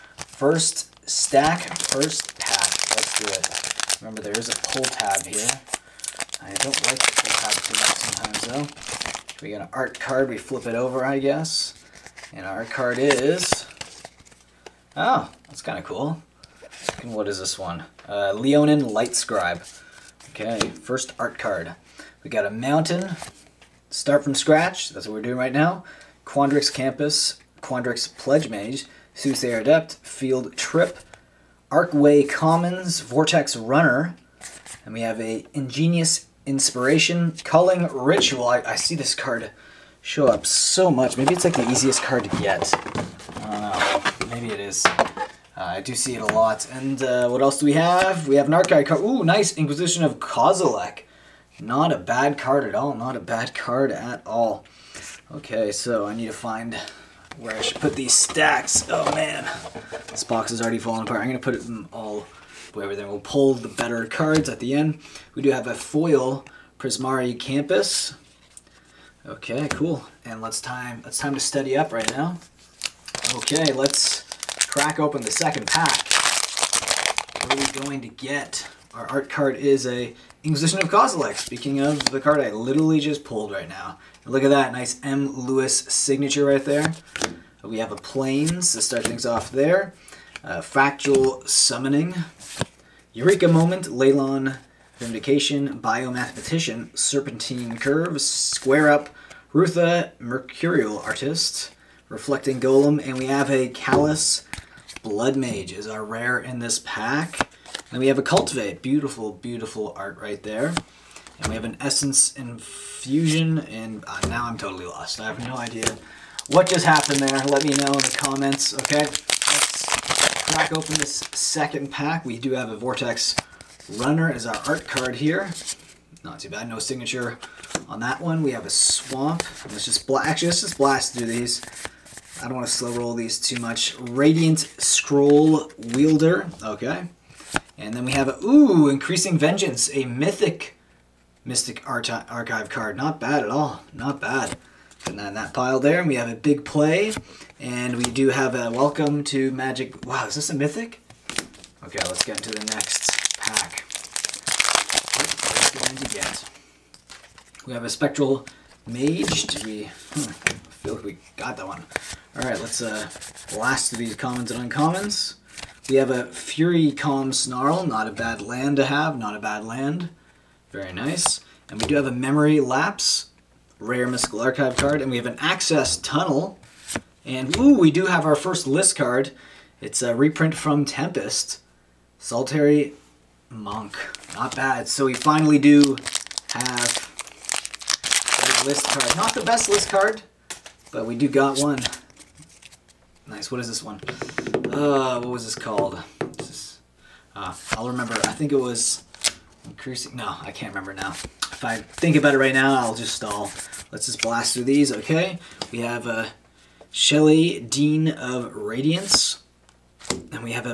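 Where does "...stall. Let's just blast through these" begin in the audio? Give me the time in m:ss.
3:23.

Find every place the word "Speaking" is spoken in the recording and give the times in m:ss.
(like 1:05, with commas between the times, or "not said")
1:21.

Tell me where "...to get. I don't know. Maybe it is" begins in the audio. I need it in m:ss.
0:42.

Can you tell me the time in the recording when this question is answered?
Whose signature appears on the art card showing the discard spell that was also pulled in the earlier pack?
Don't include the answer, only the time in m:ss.
1:25.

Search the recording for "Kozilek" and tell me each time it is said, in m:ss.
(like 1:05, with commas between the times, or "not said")
0:50, 1:20.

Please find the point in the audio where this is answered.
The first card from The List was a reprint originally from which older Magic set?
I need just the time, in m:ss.
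3:00.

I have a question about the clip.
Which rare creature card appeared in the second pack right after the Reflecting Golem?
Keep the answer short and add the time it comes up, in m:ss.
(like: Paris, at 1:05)
Callous Blood Mage, at 1:43.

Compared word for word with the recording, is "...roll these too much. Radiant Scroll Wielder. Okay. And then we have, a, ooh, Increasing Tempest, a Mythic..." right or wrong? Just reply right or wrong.
wrong.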